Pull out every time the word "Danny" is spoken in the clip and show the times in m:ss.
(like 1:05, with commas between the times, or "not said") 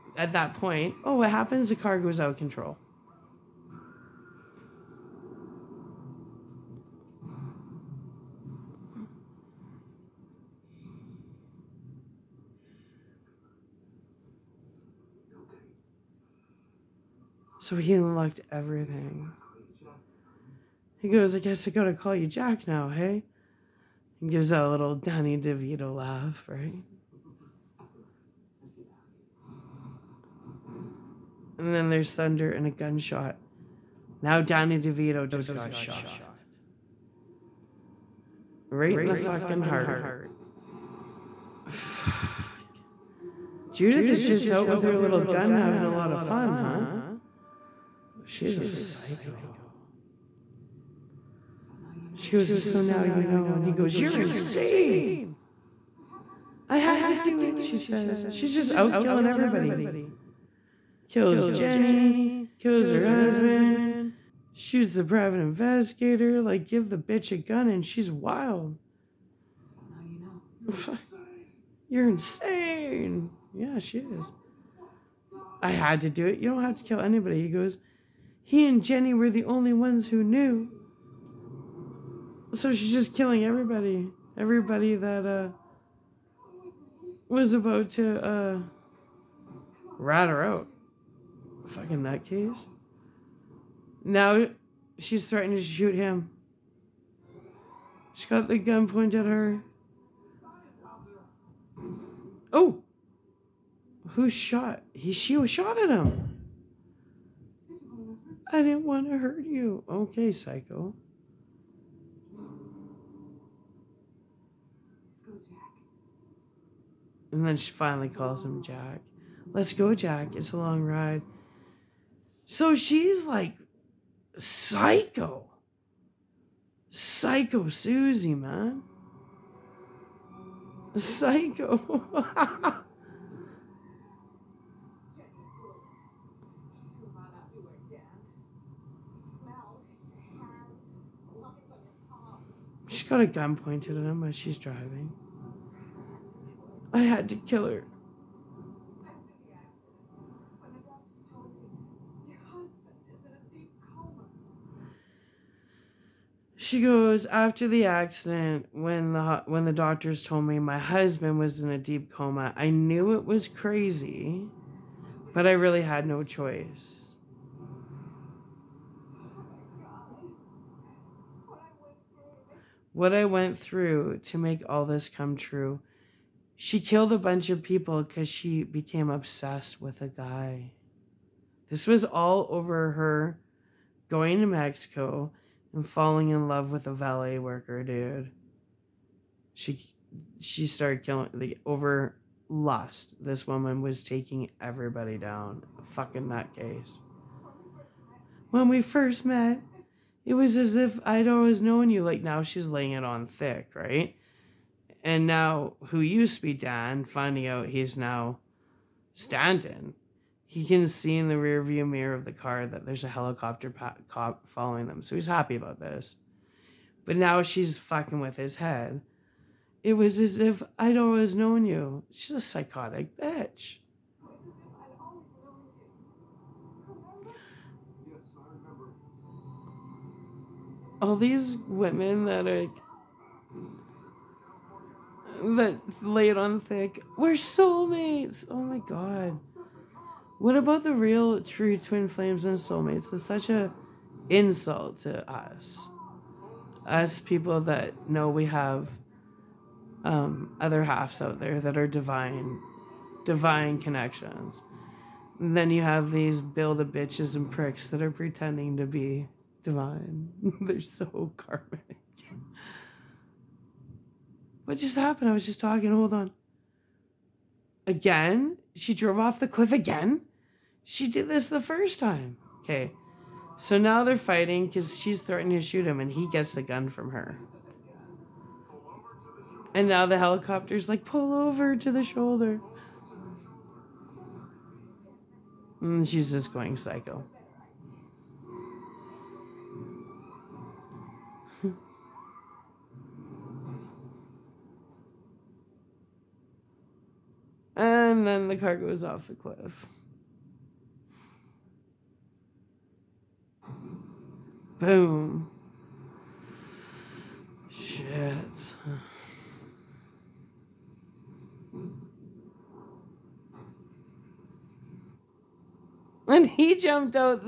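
0:24, 0:34.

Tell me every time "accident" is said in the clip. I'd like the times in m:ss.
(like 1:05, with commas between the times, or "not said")
2:37.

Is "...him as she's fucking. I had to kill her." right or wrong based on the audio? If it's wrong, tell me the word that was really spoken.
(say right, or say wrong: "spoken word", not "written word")
wrong: "driving", not "fucking".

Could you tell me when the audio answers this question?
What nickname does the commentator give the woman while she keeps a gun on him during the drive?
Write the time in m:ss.
2:06.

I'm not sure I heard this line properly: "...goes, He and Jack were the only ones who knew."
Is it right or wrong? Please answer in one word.
wrong.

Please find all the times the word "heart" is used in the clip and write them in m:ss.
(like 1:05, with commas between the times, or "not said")
0:39.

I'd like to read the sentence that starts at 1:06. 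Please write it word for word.
Like, give the bitch a gun and she's wild.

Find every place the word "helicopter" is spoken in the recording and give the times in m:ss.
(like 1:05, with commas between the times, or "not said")
3:33, 4:40.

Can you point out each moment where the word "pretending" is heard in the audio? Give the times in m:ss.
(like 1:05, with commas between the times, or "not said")
4:18.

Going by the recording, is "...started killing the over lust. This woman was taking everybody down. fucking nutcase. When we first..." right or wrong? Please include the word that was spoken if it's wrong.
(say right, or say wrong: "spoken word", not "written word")
right.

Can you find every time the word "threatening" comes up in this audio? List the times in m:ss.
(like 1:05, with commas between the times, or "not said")
1:35, 4:35.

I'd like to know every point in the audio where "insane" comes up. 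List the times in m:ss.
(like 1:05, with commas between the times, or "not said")
0:54, 1:12.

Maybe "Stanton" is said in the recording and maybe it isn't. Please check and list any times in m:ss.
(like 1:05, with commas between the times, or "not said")
3:29.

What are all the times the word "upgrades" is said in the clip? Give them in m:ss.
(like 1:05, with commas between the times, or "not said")
not said.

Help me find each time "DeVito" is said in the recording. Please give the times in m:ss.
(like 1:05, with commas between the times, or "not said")
0:25, 0:34.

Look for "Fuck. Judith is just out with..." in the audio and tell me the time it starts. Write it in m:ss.
0:41.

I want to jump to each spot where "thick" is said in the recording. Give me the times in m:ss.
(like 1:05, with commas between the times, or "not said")
3:23, 3:56.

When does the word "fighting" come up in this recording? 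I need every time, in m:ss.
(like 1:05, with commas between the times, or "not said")
4:34.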